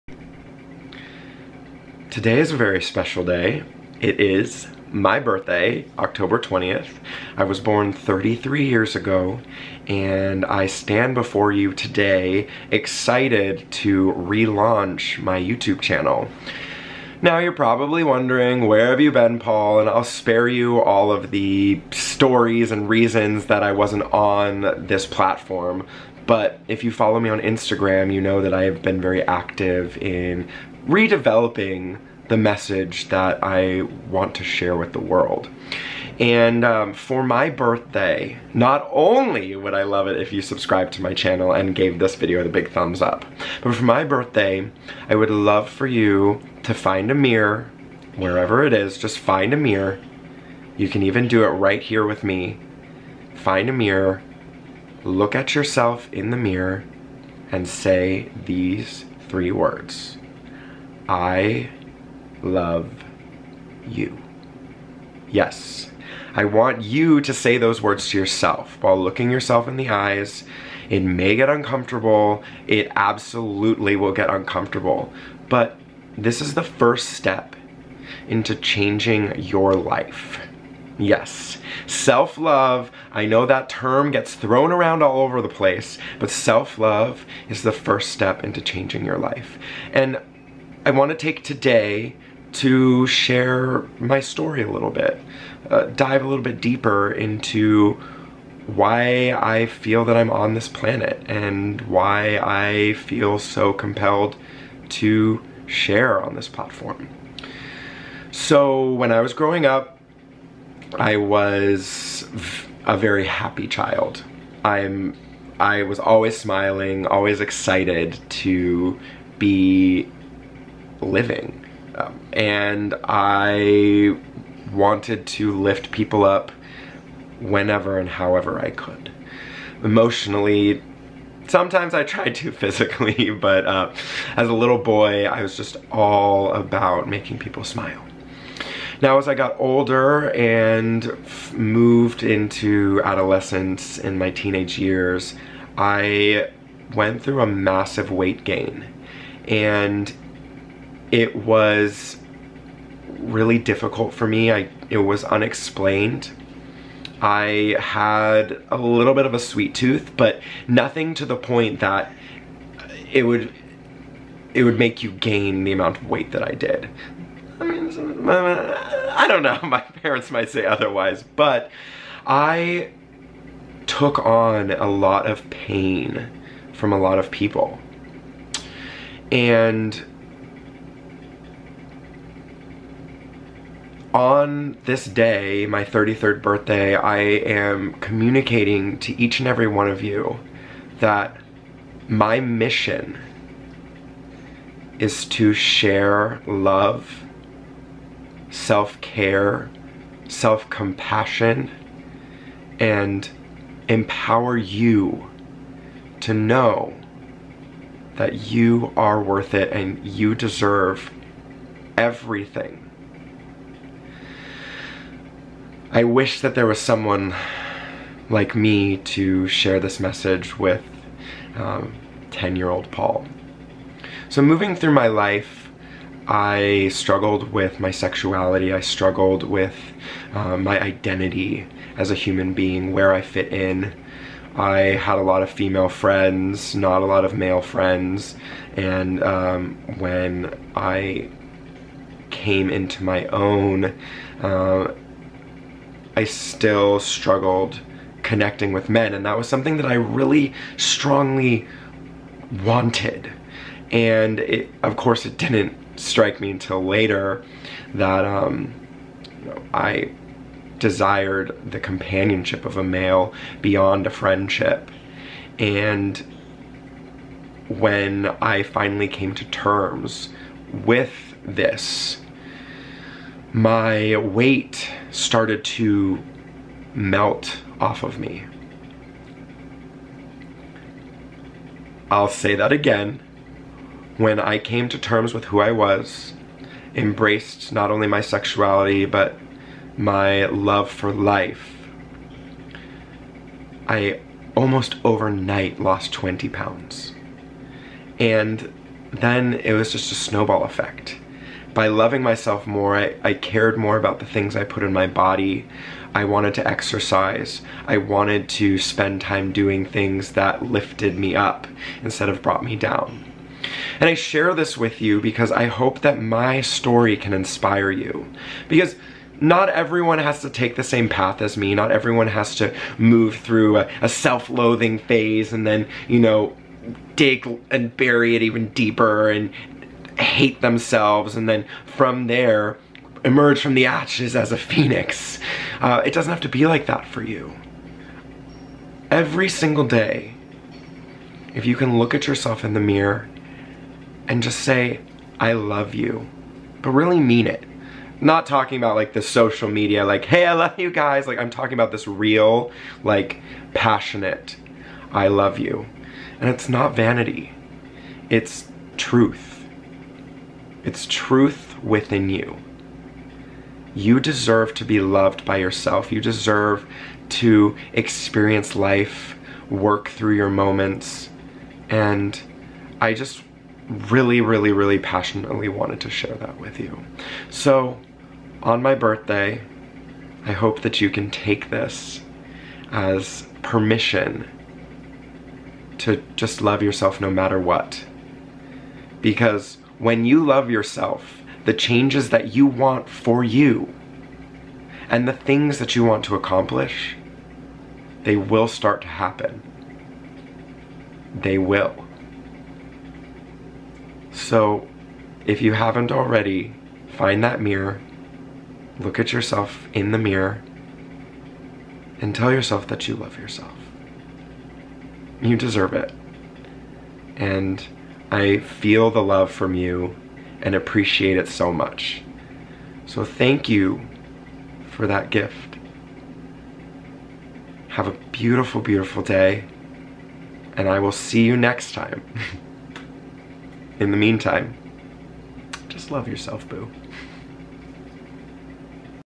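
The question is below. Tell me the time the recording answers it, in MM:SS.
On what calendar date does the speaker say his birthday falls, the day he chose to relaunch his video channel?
00:05.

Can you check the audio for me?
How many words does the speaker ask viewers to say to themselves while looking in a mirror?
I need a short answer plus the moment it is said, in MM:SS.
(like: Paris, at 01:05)
3, at 00:59.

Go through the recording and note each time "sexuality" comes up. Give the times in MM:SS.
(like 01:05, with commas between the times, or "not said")
03:47, 04:48.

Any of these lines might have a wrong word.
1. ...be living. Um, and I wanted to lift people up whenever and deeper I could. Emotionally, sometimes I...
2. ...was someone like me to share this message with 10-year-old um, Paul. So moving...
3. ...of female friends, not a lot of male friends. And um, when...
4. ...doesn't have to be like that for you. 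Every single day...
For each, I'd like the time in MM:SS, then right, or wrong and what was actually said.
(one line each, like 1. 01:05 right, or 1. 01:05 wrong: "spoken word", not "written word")
1. 01:59 wrong: "however", not "deeper"
2. 03:36 right
3. 03:55 right
4. 05:36 right.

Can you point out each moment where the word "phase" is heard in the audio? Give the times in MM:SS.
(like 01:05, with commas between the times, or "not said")
05:24.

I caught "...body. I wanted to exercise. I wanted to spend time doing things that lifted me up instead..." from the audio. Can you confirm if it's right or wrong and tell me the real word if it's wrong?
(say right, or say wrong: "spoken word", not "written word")
right.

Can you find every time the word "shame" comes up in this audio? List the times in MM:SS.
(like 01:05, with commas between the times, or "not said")
not said.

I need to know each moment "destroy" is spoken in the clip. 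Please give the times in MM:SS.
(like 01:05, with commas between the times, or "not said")
not said.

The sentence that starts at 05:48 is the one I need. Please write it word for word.
Not talking about like the social media, like, hey, I love you guys.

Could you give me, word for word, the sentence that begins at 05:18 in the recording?
Because not everyone has to take the same path as me.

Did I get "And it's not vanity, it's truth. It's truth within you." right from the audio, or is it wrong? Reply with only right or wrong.
right.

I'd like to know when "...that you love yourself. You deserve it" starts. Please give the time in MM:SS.
06:52.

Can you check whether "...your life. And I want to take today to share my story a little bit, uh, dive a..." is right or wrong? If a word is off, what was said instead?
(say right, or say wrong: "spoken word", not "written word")
right.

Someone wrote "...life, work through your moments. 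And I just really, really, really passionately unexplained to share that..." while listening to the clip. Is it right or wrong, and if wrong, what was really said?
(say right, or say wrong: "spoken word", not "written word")
wrong: "wanted", not "unexplained".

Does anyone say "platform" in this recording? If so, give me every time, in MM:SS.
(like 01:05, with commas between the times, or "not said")
00:25, 01:46.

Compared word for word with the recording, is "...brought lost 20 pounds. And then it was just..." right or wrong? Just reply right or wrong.
wrong.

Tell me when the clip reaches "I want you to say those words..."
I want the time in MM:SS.
01:06.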